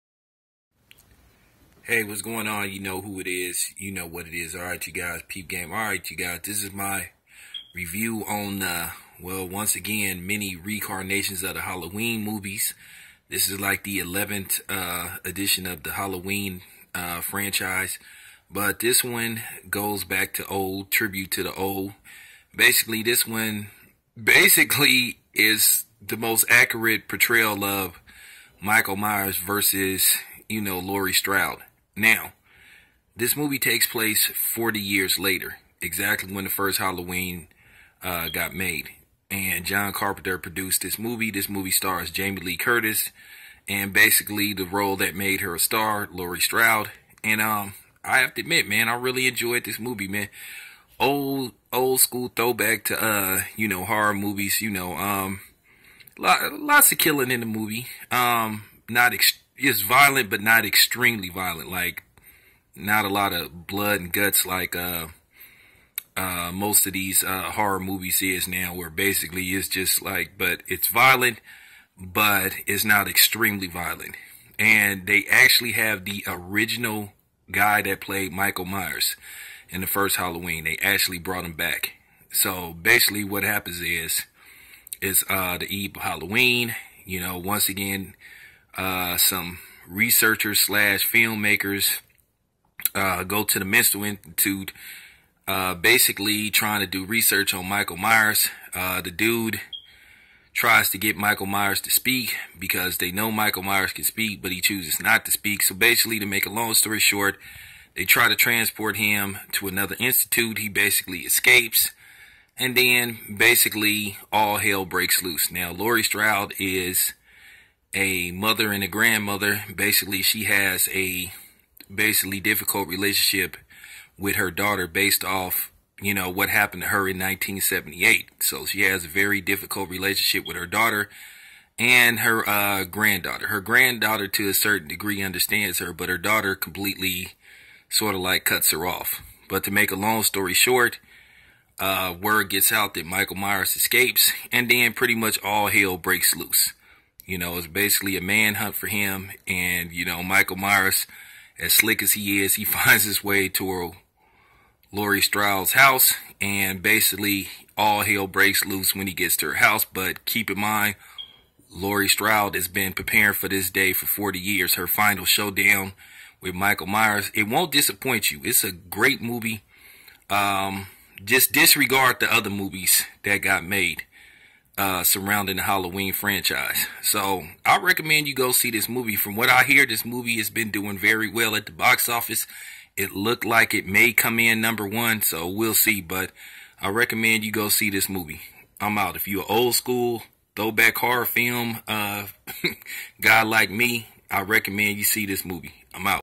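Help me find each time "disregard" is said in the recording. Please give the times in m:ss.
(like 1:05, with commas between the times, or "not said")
2:51.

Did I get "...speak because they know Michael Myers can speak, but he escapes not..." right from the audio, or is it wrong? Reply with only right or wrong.
wrong.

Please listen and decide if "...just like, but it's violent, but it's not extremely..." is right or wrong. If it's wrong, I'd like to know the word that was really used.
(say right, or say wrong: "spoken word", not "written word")
right.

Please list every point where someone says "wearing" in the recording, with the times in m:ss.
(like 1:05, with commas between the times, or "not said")
not said.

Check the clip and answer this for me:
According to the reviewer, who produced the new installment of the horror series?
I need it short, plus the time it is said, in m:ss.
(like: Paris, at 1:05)
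John Carpenter, at 0:39.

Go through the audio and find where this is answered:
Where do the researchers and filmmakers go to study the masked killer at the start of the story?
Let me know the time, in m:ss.
1:33.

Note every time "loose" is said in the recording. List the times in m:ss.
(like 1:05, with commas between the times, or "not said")
1:55, 2:26, 2:38.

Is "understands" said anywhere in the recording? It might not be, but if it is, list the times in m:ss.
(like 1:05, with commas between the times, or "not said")
2:15.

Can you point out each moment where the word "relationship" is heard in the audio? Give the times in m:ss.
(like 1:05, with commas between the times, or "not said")
2:02, 2:09.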